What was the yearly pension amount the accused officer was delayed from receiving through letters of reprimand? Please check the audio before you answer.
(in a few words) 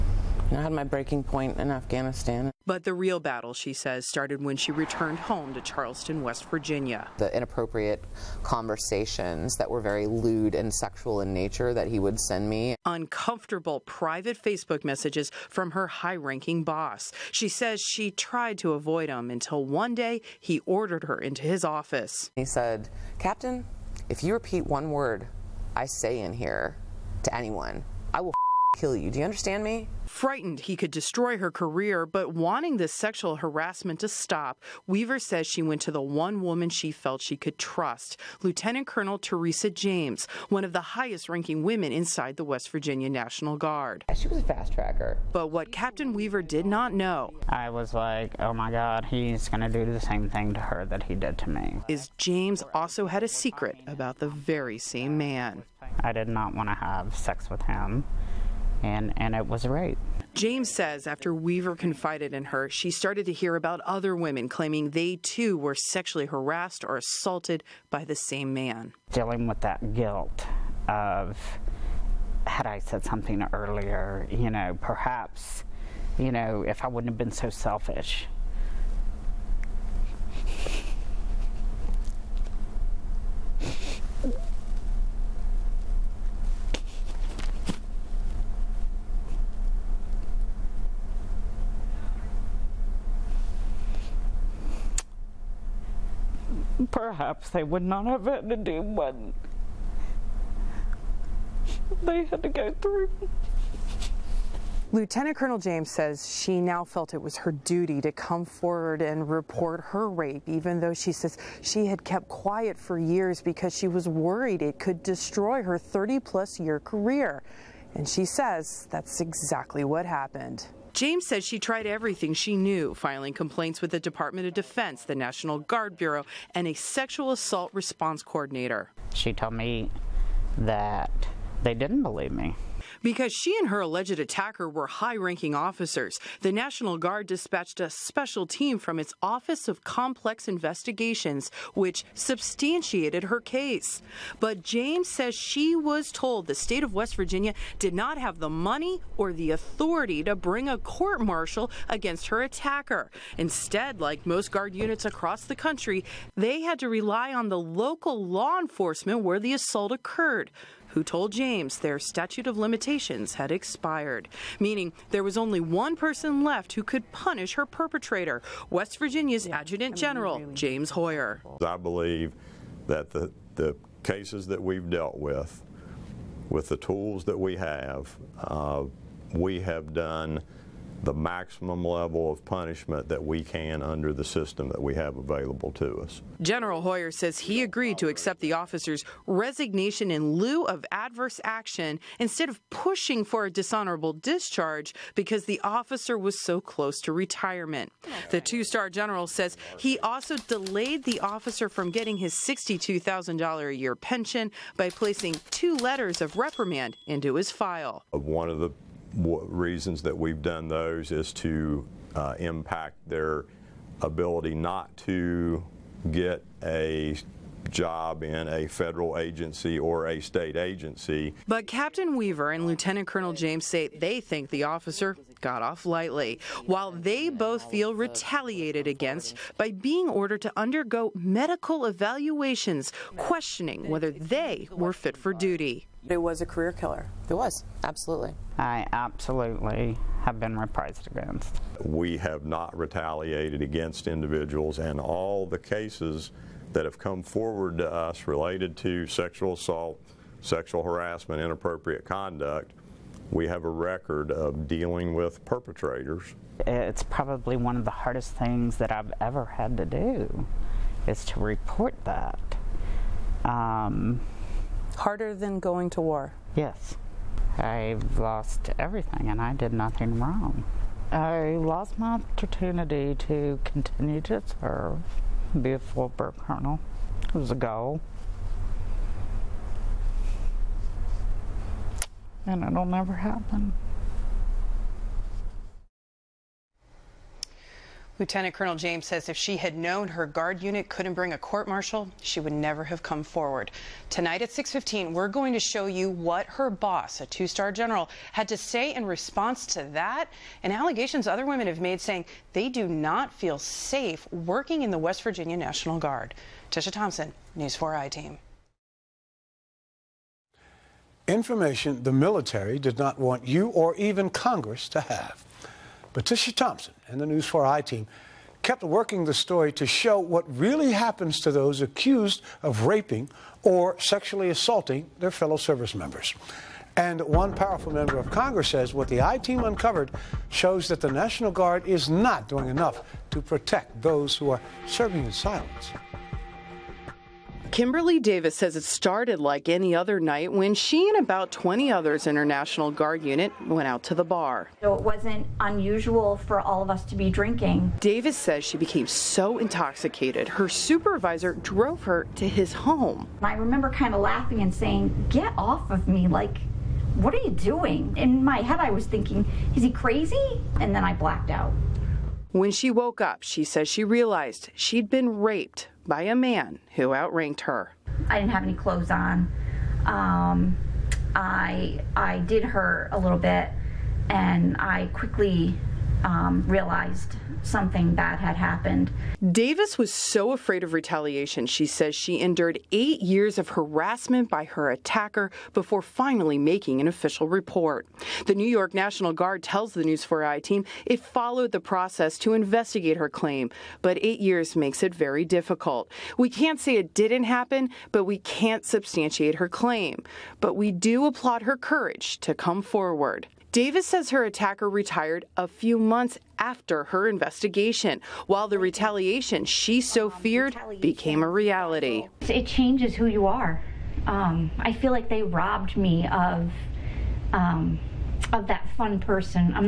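$62,000.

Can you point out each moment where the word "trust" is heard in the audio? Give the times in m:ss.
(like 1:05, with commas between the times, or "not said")
0:37.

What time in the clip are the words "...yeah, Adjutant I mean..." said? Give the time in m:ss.
2:49.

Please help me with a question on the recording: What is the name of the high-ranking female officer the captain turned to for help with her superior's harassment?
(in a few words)
Teresa James.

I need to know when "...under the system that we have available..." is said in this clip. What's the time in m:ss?
3:03.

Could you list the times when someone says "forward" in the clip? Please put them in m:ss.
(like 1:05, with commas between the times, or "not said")
1:48, 4:07, 4:53, 6:42.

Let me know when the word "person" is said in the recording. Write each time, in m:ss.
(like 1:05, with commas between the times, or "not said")
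2:45, 6:59.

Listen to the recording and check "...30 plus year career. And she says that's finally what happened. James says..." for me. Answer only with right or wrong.
wrong.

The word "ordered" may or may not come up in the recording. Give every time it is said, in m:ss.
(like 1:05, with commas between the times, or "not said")
0:20, 3:50.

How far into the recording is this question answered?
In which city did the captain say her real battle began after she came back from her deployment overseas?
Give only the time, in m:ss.
0:05.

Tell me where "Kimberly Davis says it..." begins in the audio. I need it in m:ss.
5:37.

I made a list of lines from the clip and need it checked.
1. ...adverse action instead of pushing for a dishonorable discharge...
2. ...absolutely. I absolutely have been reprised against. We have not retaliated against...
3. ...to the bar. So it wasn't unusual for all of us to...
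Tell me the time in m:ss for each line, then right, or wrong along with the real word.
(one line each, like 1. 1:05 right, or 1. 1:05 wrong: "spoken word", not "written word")
1. 3:10 right
2. 3:57 right
3. 5:44 right.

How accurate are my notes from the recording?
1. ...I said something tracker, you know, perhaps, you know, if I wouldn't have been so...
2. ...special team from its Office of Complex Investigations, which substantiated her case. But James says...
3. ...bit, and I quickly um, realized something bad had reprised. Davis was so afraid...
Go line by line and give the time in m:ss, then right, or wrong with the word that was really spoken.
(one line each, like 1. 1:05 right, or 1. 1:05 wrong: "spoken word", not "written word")
1. 1:12 wrong: "earlier", not "tracker"
2. 2:17 right
3. 6:13 wrong: "happened", not "reprised".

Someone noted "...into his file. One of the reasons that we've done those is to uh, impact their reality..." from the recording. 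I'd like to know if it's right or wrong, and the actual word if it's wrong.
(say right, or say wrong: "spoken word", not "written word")
wrong: "ability", not "reality".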